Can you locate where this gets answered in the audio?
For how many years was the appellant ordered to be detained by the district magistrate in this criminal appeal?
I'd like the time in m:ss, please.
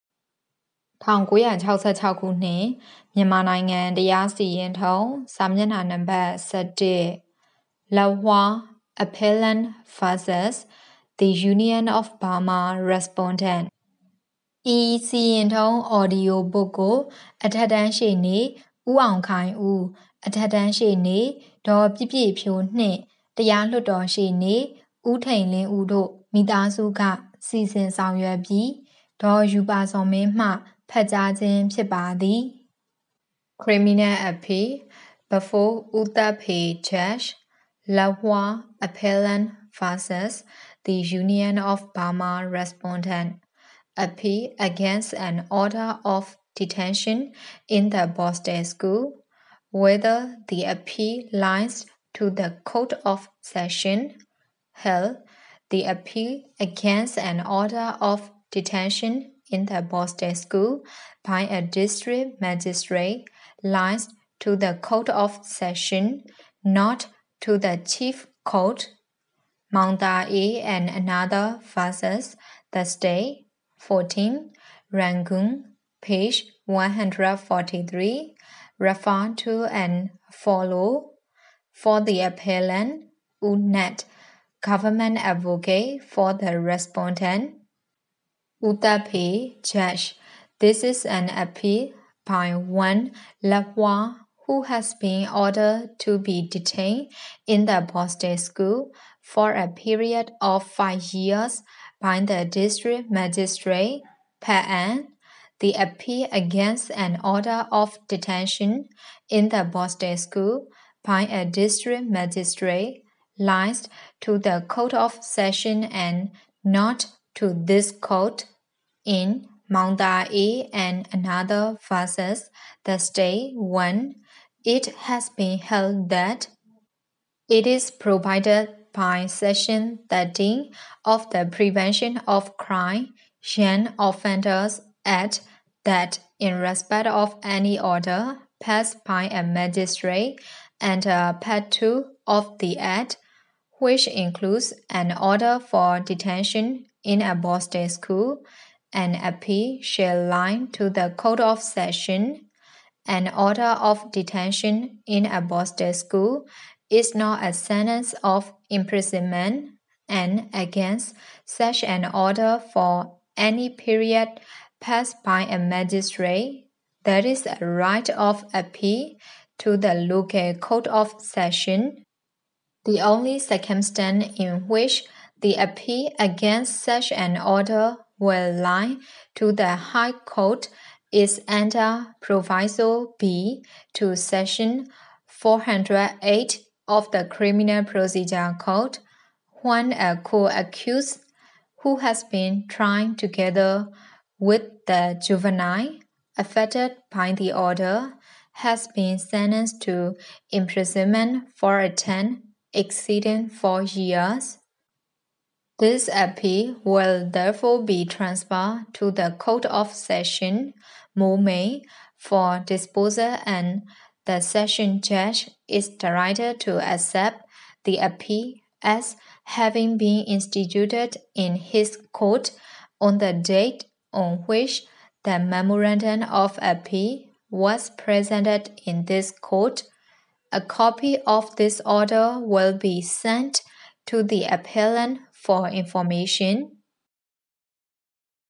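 1:40.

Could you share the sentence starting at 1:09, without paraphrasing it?
Mandae and another versus the state.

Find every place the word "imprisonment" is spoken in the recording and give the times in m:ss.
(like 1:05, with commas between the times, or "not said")
2:38, 3:20.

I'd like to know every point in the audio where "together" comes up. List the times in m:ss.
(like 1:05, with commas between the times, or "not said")
3:13.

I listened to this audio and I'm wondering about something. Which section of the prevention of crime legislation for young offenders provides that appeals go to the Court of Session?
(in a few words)
Section 13.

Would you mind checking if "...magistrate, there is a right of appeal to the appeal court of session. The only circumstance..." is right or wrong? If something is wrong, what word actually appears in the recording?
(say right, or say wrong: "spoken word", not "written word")
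wrong: "local", not "appeal".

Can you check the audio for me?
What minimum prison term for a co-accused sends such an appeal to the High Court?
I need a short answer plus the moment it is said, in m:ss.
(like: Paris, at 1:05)
4, at 3:23.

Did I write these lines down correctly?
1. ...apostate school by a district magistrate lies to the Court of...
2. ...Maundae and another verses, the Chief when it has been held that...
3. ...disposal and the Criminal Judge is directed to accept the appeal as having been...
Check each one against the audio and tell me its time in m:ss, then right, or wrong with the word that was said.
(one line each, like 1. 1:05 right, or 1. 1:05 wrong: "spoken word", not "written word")
1. 1:49 right
2. 1:59 wrong: "Thursday", not "Chief"
3. 3:32 wrong: "Session", not "Criminal".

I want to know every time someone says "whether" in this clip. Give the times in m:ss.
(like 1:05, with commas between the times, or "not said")
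0:49.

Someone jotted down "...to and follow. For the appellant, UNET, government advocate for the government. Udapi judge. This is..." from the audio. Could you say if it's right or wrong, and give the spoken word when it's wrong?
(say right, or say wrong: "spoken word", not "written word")
wrong: "respondent", not "government".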